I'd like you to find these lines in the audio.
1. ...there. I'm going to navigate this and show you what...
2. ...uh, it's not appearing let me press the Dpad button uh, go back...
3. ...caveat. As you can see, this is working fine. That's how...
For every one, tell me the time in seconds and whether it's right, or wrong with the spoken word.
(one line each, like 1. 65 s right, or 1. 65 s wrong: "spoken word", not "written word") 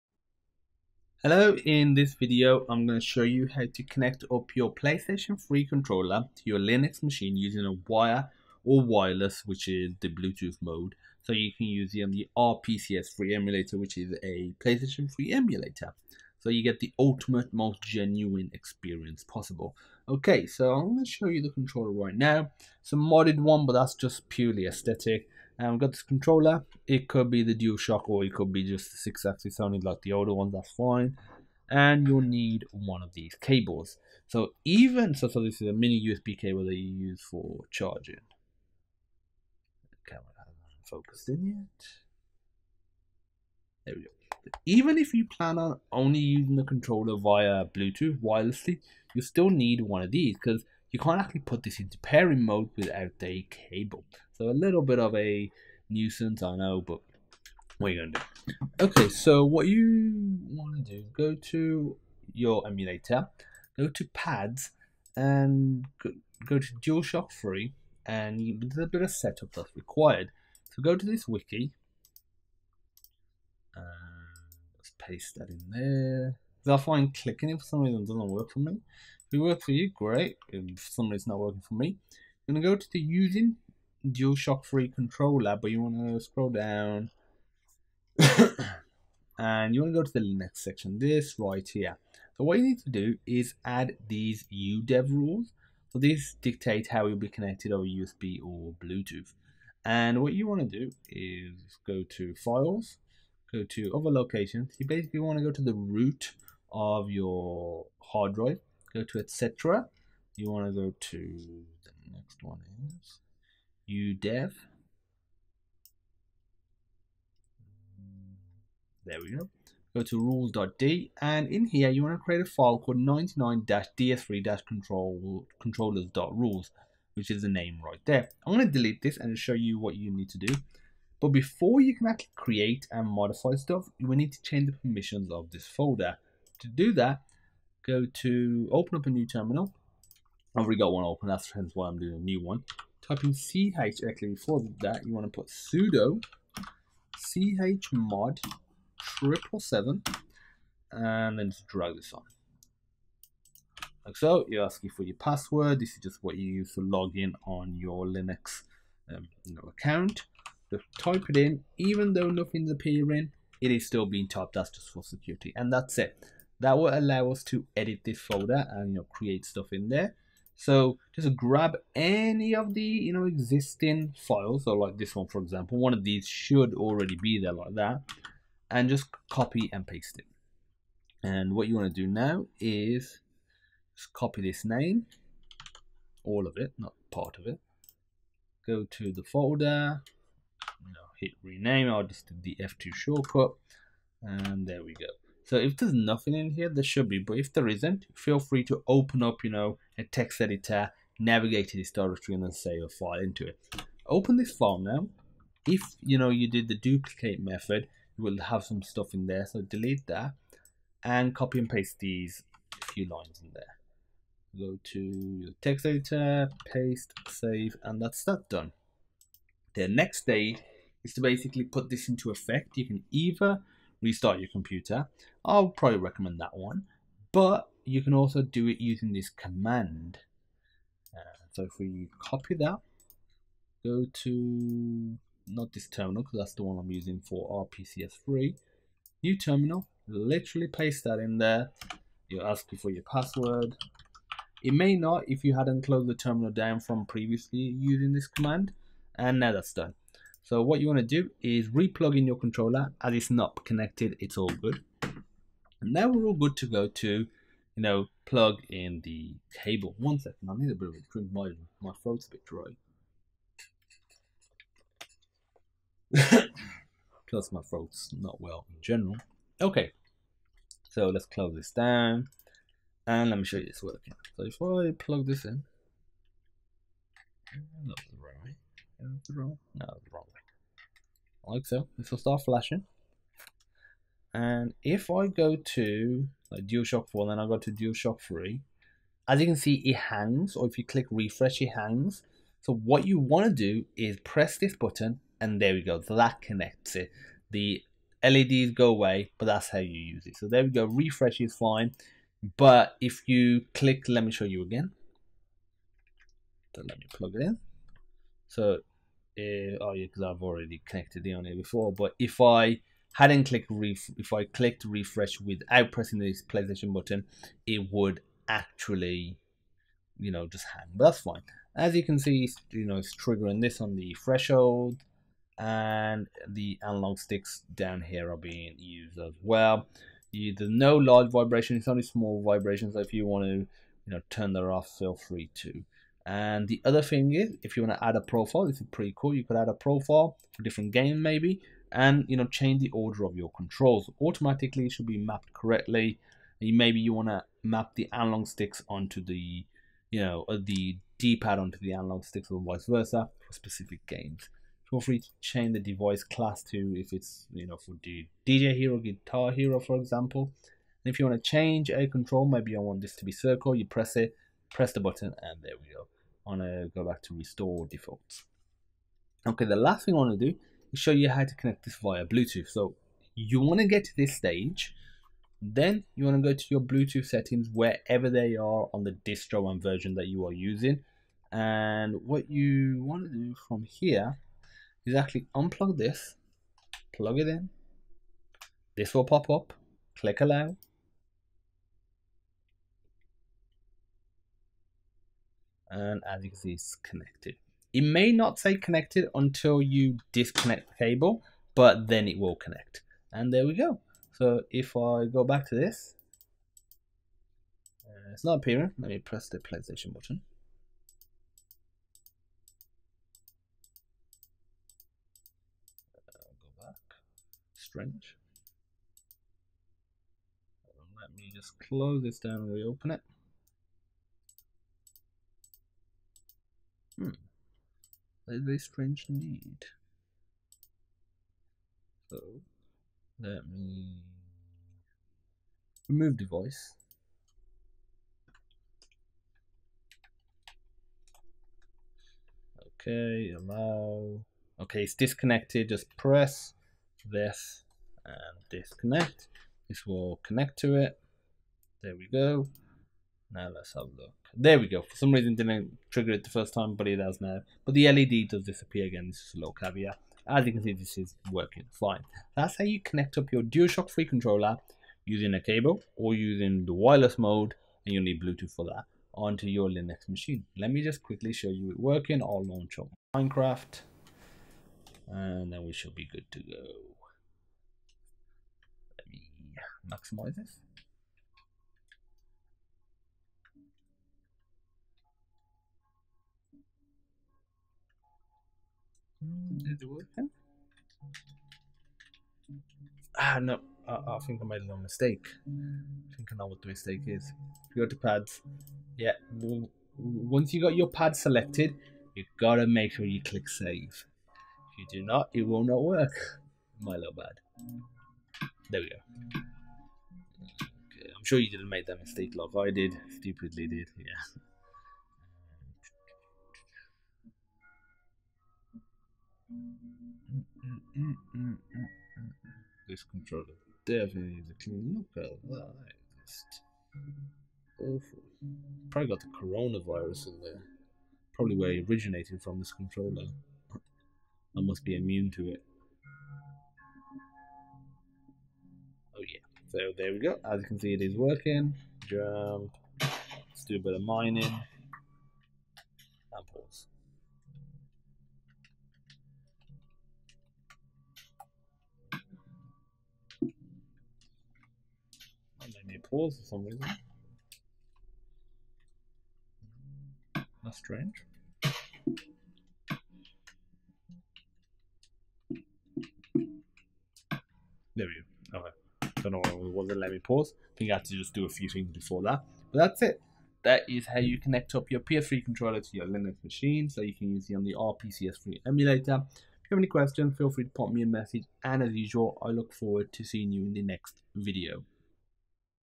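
1. 128 s wrong: "delete", not "navigate"
2. 408 s wrong: "PlayStation", not "Dpad"
3. 459 s right.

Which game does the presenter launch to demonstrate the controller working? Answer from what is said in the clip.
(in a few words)
Minecraft.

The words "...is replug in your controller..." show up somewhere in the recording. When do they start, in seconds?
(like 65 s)
251 s.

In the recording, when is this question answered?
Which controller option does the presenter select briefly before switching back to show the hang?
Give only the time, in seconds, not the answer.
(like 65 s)
286 s.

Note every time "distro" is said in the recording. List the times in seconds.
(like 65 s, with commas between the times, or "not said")
379 s.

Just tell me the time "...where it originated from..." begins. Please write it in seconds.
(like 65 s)
531 s.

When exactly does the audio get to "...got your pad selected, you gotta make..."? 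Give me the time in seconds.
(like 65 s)
500 s.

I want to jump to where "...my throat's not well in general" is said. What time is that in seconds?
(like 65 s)
267 s.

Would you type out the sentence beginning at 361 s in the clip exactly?
And if you want to change a control, maybe I want this to be circle.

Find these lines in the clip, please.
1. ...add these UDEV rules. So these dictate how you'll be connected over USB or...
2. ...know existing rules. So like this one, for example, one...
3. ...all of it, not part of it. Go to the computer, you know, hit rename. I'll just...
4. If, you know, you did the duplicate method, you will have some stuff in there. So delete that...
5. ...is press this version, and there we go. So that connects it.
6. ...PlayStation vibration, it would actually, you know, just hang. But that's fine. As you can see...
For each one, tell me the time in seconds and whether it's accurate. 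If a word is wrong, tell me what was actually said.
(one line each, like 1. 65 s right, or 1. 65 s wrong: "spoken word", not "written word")
1. 93 s right
2. 173 s wrong: "files", not "rules"
3. 186 s wrong: "folder", not "computer"
4. 205 s right
5. 293 s wrong: "button", not "version"
6. 316 s wrong: "button", not "vibration".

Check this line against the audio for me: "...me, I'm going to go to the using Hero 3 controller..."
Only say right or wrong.
wrong.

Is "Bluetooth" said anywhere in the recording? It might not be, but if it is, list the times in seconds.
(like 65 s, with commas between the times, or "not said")
10 s, 47 s, 98 s, 372 s, 376 s, 468 s.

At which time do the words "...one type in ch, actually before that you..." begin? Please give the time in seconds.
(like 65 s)
142 s.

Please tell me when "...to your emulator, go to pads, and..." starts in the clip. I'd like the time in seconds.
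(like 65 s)
61 s.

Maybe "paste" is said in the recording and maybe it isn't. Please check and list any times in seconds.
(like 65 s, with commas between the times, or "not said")
74 s, 179 s, 211 s, 216 s, 240 s.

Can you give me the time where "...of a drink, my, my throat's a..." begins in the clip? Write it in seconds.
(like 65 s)
260 s.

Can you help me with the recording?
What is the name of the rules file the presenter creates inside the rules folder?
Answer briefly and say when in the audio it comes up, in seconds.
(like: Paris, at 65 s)
99-ds3-controllers.rules, at 122 s.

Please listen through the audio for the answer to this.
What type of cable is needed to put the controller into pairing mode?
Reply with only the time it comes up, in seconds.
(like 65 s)
35 s.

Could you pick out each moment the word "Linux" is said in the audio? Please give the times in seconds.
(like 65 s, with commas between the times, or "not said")
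6 s, 158 s, 469 s, 576 s.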